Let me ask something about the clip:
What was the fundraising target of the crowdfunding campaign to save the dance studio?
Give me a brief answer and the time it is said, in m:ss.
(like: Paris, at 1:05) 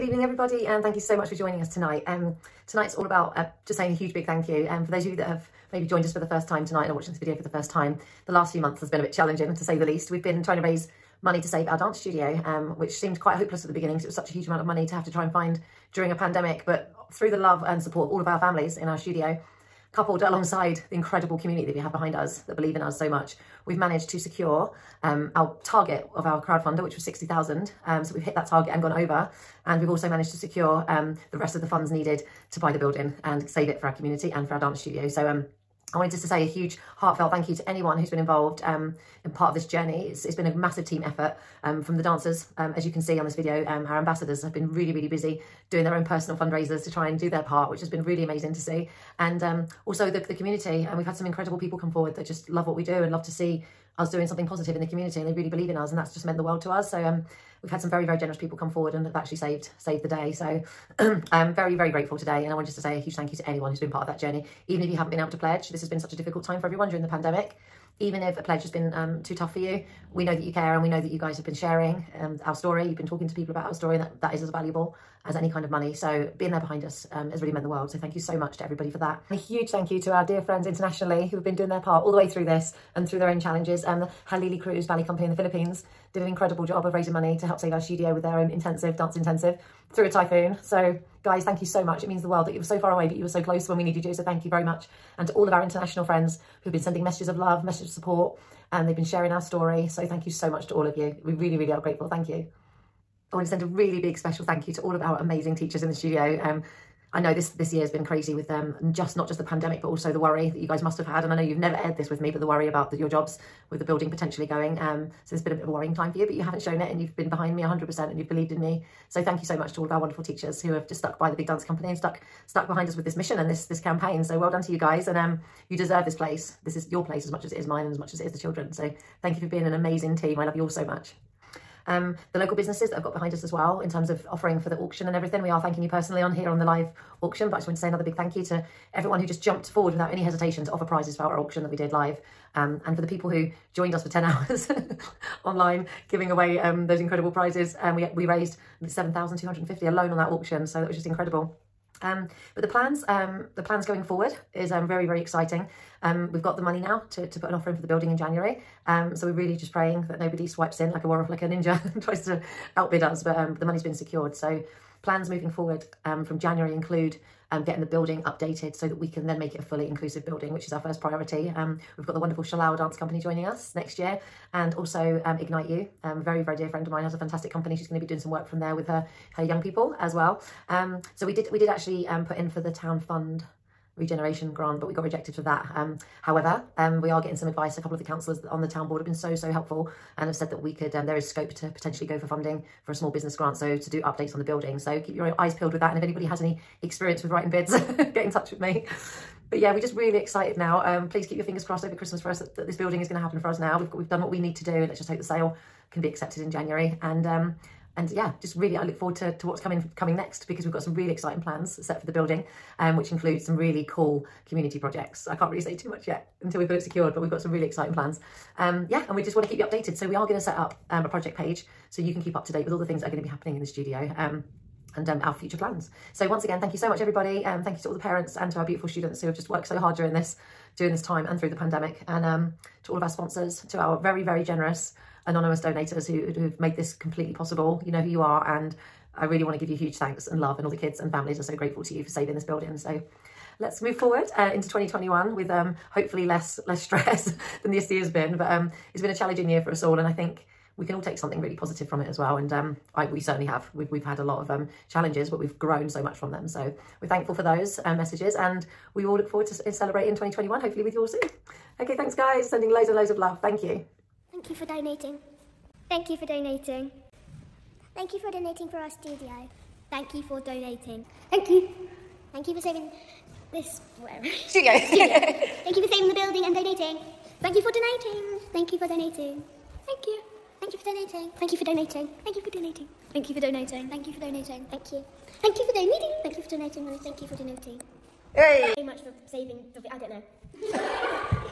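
60,000, at 0:27.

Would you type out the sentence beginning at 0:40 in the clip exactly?
It's, it's been a massive team effort um, from the dancers.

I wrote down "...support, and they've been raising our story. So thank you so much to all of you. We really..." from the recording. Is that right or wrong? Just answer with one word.
wrong.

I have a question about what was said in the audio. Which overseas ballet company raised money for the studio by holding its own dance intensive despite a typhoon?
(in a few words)
Halili Cruise Ballet Company.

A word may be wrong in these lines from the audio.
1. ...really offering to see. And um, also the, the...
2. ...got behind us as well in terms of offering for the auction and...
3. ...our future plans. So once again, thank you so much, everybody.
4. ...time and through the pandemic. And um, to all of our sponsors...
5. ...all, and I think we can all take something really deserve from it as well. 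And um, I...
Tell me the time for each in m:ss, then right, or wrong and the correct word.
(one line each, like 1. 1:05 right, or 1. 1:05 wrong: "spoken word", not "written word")
1. 0:48 wrong: "amazing", not "offering"
2. 2:13 right
3. 3:45 right
4. 3:51 right
5. 4:09 wrong: "positive", not "deserve".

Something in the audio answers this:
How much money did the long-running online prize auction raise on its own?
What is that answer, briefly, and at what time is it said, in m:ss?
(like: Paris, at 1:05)
7,250, at 2:28.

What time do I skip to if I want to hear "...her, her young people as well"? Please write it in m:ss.
2:58.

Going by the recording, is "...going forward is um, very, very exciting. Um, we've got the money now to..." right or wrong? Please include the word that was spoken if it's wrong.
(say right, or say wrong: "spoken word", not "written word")
right.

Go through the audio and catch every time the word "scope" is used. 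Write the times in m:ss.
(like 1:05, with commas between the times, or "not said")
3:11.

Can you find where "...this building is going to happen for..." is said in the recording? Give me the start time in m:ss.
3:22.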